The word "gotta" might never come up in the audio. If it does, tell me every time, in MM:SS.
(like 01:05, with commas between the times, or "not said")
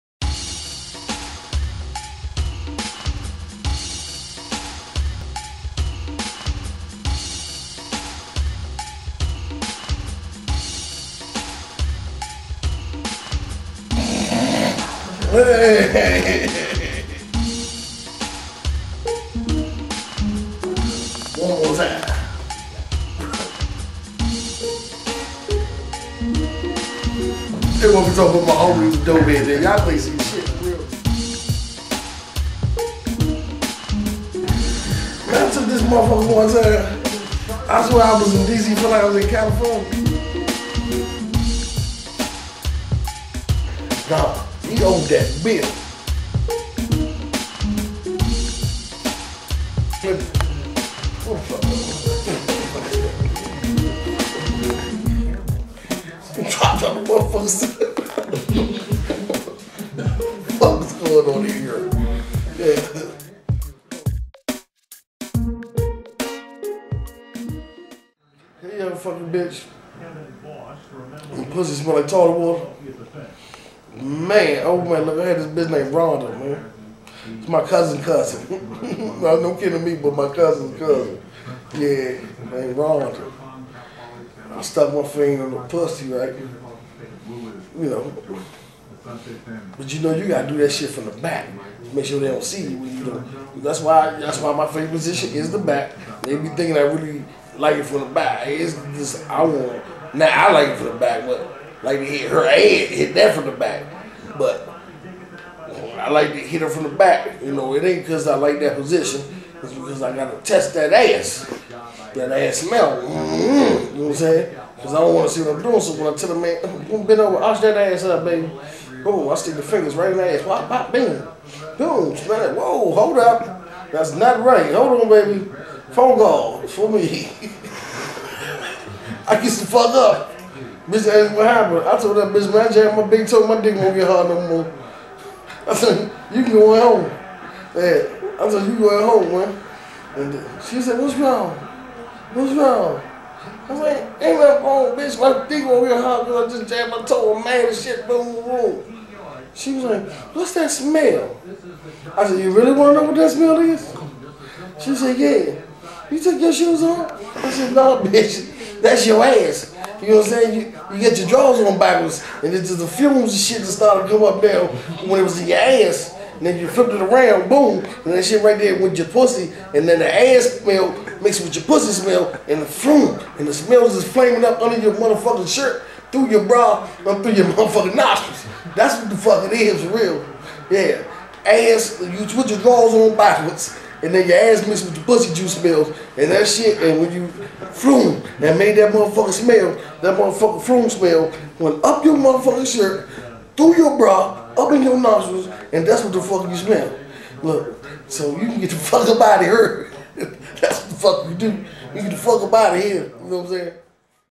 01:30, 01:50.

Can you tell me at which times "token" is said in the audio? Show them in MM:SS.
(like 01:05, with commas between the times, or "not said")
not said.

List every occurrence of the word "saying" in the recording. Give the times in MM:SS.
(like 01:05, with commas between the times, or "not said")
01:54, 02:40, 03:23.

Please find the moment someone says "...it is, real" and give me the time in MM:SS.
02:59.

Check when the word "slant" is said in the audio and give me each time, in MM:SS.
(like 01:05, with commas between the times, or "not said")
not said.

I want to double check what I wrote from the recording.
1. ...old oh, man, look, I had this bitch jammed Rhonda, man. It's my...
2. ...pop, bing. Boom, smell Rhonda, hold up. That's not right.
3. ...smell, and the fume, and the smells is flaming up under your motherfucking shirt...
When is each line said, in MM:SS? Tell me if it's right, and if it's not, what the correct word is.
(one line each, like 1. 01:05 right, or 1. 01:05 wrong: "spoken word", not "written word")
1. 01:14 wrong: "named", not "jammed"
2. 02:00 wrong: "Whoa", not "Rhonda"
3. 02:51 right.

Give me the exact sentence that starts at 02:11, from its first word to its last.
I told that bitch, man, I jammed my big toe, my dick won't get hard no more.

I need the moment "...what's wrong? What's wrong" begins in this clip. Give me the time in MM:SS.
02:20.